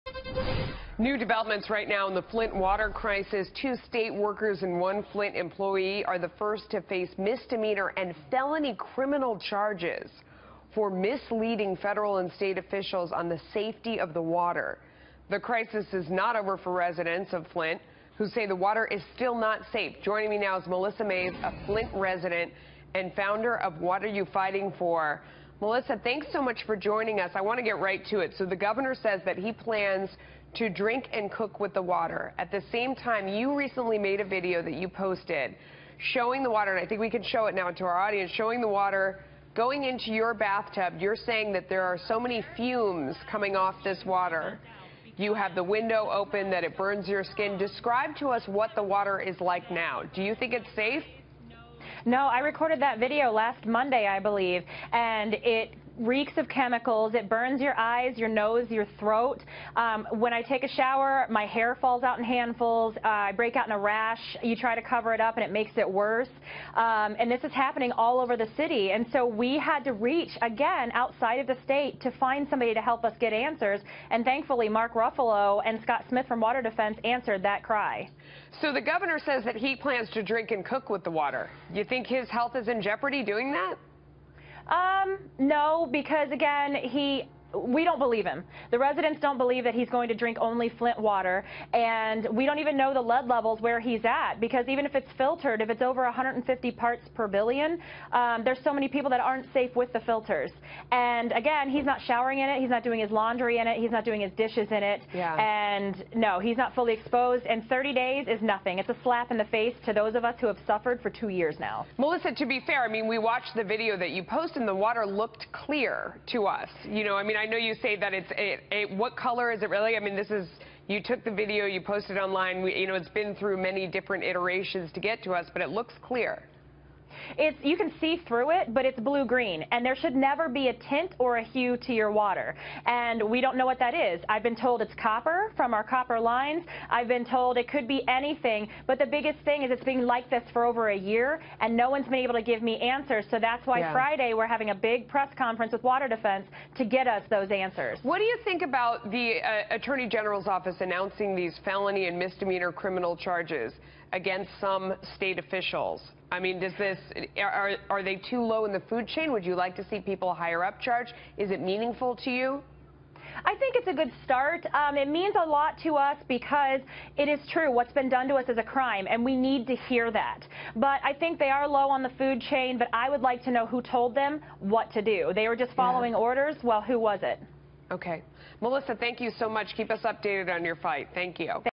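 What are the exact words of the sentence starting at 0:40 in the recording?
You're saying that there are so many fumes coming off this water.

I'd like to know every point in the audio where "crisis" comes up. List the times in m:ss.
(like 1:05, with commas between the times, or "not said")
0:02, 0:15.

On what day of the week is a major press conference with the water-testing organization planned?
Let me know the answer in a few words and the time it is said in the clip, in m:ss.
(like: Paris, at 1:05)
Friday, at 2:23.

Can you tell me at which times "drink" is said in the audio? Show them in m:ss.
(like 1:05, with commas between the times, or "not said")
0:30, 1:20, 1:30.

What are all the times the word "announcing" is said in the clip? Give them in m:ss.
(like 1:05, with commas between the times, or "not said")
2:30.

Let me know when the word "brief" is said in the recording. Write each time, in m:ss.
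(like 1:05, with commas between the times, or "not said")
not said.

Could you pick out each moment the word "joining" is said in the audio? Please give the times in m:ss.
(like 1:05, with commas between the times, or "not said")
0:20, 0:26.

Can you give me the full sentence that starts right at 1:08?
And so we had to reach, again, outside of the state to find somebody to help us get answers.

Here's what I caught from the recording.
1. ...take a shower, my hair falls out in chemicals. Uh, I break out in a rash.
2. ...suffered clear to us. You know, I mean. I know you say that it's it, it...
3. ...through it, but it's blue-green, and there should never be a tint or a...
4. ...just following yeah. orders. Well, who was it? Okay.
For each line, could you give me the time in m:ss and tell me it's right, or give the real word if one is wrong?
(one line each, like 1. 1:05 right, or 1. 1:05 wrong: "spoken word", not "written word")
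1. 1:00 wrong: "handfuls", not "chemicals"
2. 1:55 wrong: "looked", not "suffered"
3. 2:08 right
4. 2:55 right.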